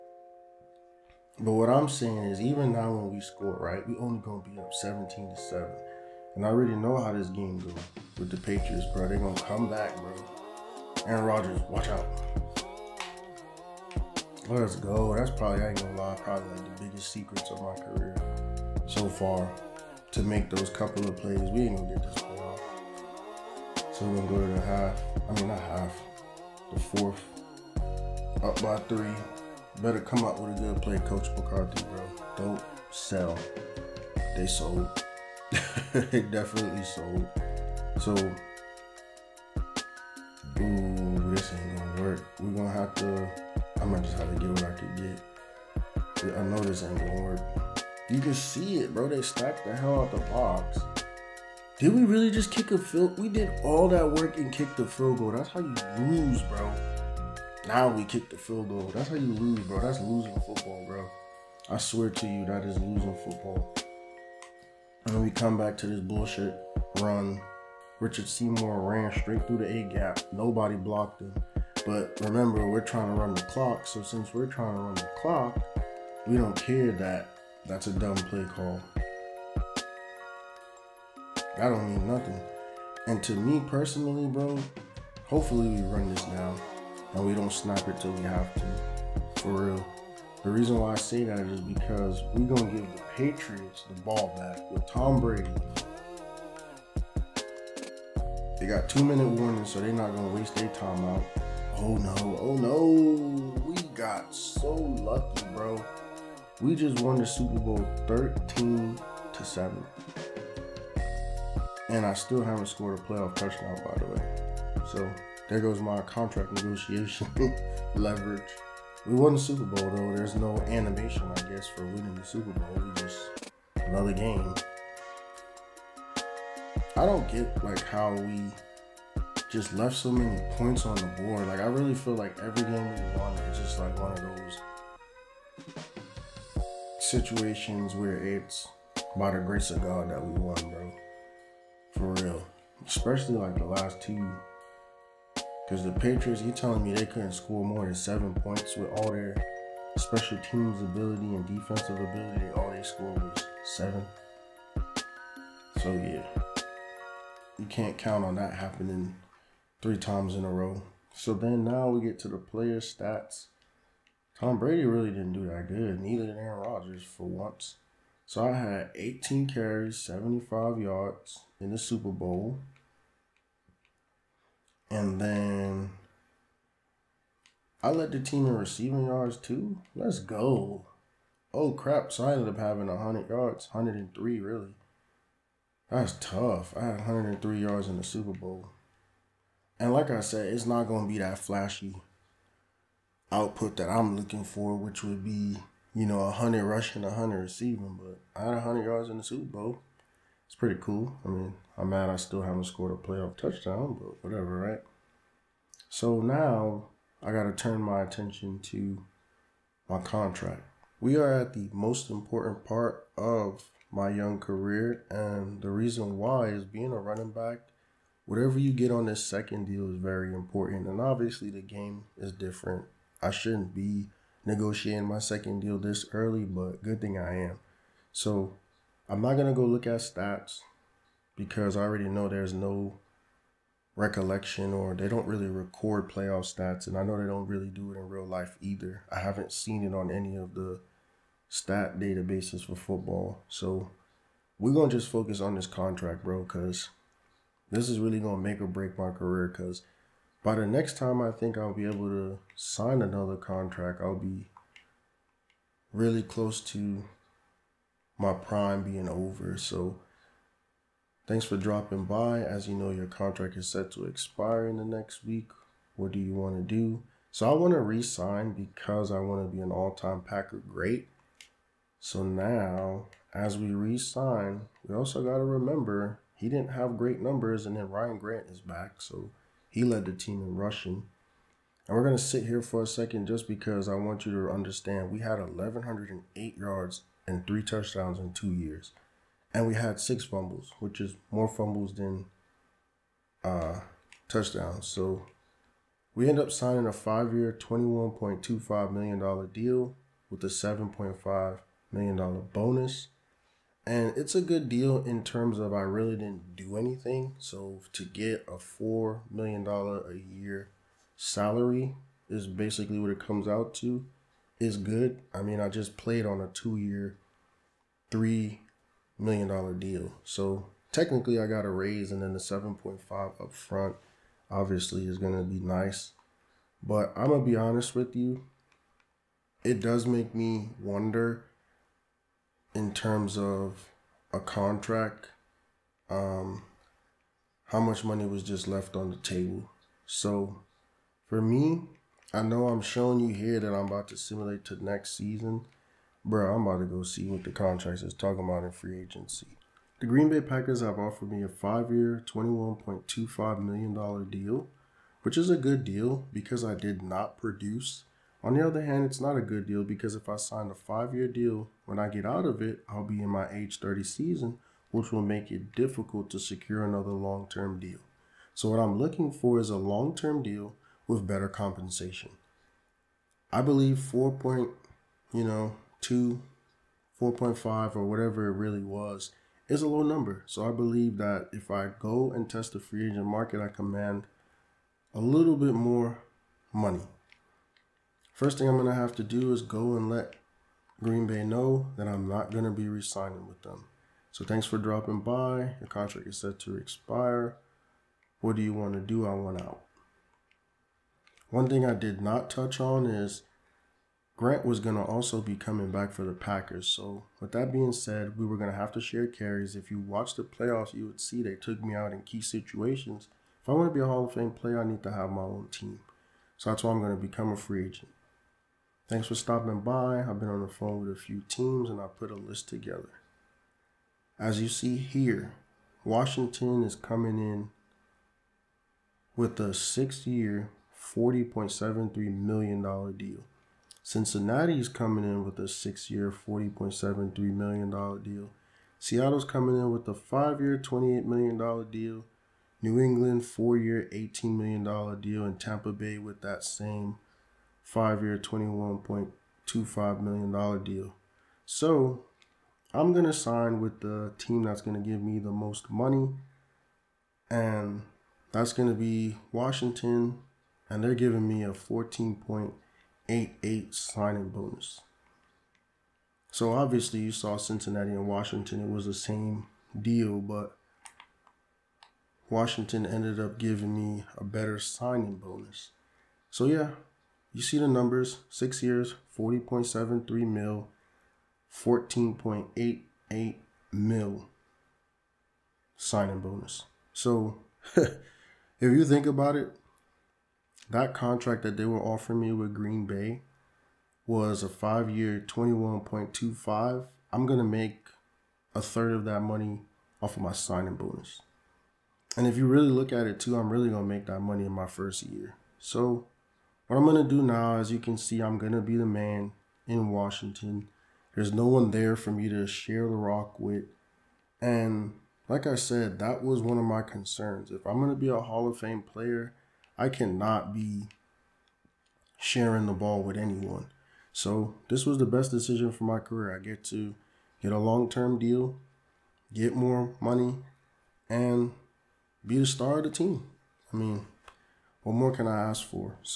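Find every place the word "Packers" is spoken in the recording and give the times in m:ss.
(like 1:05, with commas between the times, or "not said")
4:30, 5:50, 6:46.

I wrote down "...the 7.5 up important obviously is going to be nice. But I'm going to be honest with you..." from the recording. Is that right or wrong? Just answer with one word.
wrong.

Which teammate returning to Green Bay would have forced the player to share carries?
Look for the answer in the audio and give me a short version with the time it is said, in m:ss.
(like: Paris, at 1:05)
Ryan Grant, at 4:37.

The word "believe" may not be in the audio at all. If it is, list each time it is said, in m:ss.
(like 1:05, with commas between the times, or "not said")
6:13, 6:20.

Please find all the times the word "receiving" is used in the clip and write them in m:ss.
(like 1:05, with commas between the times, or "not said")
2:58, 3:17.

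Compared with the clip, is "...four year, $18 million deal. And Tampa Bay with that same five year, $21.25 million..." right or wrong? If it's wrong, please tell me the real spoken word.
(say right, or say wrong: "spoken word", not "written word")
right.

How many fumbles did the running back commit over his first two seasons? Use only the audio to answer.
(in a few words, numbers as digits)
6.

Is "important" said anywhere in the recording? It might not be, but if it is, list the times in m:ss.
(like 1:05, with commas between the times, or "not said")
3:32, 3:40.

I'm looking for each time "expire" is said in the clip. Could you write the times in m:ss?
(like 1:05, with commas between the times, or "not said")
4:24, 6:36.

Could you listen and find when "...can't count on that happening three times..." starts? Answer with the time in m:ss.
2:37.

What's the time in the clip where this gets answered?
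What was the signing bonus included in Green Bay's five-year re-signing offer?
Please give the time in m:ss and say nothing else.
5:00.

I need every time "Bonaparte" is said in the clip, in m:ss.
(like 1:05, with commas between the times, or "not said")
not said.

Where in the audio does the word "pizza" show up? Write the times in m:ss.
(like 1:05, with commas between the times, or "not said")
not said.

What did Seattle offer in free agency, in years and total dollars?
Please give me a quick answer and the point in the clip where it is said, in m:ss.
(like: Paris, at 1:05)
5 years, $28 million, at 7:20.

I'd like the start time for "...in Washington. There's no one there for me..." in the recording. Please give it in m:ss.
8:29.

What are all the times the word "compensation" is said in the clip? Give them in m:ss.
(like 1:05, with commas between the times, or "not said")
6:11.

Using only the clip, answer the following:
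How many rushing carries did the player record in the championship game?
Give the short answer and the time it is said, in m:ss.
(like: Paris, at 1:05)
18, at 2:48.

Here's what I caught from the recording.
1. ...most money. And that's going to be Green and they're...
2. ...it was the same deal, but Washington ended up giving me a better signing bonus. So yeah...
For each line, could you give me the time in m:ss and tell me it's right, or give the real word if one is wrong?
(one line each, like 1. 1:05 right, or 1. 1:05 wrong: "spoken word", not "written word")
1. 7:35 wrong: "Washington", not "Green"
2. 7:48 right.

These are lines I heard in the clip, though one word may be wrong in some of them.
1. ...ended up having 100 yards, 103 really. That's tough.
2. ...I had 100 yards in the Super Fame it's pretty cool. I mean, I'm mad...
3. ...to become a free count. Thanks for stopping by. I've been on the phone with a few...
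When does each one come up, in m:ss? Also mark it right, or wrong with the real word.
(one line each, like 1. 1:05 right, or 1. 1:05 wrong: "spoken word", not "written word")
1. 3:02 right
2. 3:18 wrong: "Bowl", not "Fame"
3. 6:57 wrong: "agent", not "count".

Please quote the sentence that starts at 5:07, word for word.
So to get a $4 million a year salary is basically what it comes out to is good.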